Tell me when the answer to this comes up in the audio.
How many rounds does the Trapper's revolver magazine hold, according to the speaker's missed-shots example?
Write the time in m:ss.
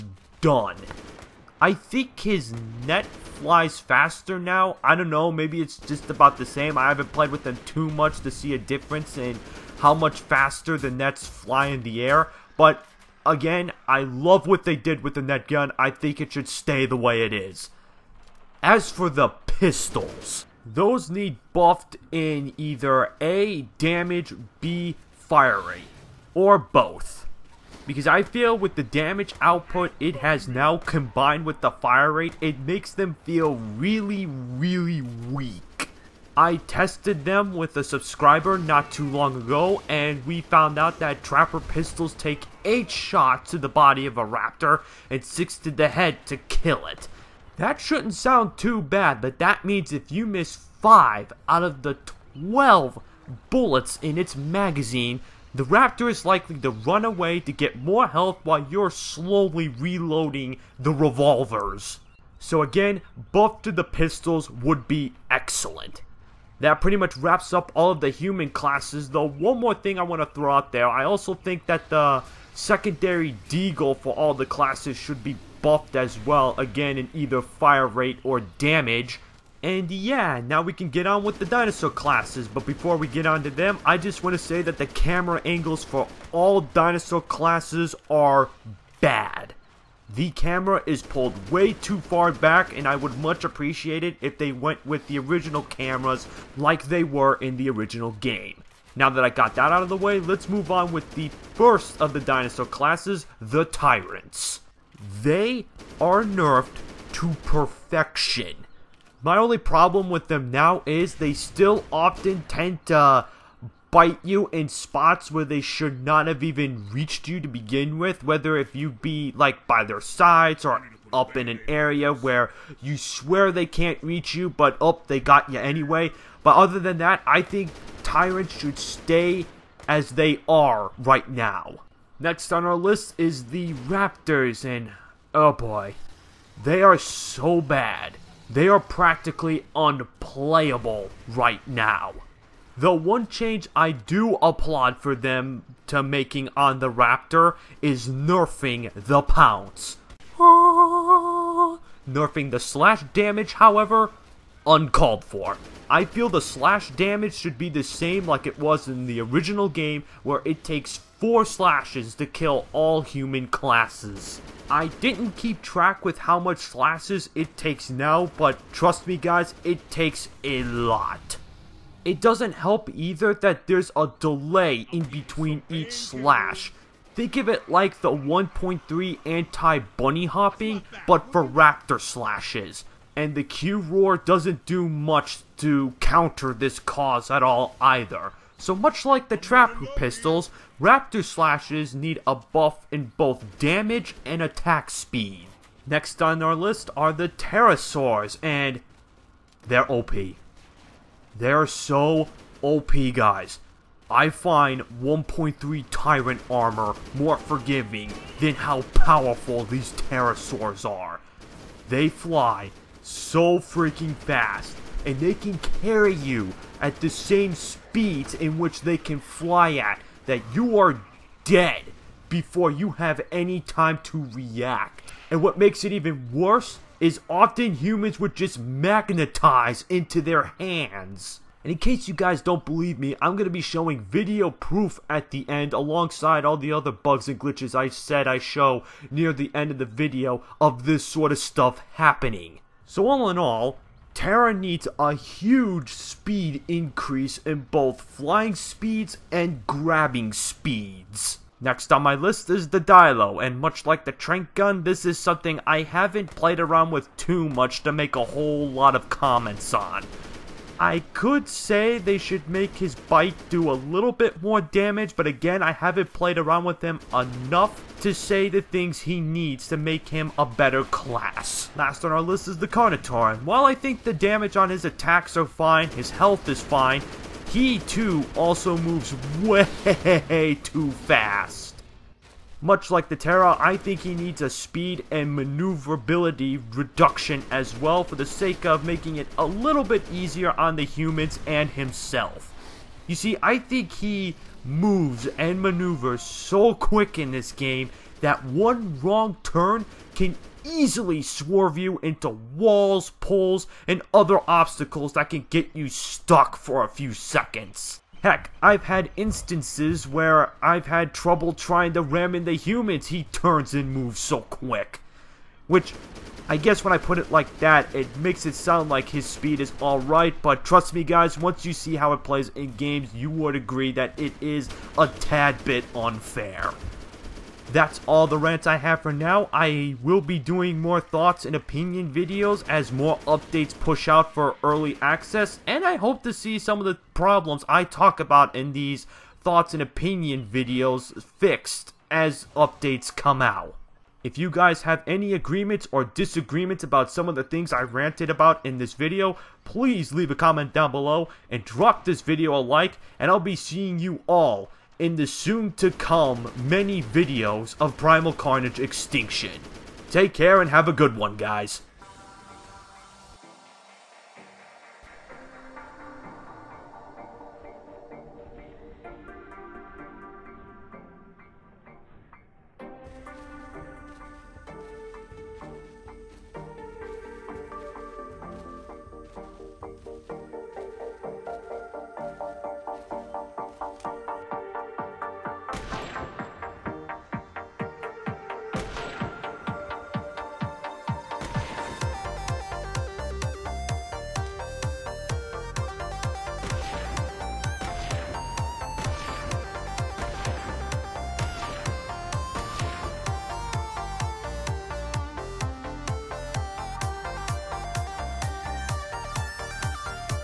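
0:52.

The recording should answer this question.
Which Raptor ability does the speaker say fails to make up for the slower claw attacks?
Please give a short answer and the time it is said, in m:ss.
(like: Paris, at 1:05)
Q-Roar, at 3:03.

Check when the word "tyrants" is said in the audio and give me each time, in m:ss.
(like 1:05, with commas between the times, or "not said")
1:43, 2:08, 3:25.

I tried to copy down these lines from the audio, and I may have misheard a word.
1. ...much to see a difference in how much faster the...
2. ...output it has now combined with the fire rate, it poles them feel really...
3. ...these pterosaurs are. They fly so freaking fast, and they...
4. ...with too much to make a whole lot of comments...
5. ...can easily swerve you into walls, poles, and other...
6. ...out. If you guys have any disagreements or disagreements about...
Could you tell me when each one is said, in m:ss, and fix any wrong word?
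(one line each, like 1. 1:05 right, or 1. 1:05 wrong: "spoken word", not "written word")
1. 0:07 right
2. 0:29 wrong: "makes", not "poles"
3. 3:29 right
4. 4:16 right
5. 5:00 right
6. 5:43 wrong: "agreements", not "disagreements".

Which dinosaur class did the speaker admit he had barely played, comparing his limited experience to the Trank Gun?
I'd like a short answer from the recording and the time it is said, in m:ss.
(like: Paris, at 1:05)
Dilo, at 4:12.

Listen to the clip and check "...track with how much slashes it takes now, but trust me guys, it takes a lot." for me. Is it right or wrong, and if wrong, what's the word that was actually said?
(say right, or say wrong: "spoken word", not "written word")
right.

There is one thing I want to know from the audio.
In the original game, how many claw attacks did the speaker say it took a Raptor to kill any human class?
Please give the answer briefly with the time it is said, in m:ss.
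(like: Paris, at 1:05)
4, at 2:41.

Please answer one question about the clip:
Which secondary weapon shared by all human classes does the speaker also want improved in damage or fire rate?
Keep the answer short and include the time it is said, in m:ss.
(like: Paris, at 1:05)
deagle, at 1:13.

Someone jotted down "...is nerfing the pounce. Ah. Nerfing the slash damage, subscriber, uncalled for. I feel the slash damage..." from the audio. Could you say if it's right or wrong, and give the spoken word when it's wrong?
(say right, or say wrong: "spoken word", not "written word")
wrong: "however", not "subscriber".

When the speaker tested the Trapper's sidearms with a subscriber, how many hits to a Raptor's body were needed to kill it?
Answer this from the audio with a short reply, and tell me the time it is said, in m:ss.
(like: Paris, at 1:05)
8, at 0:42.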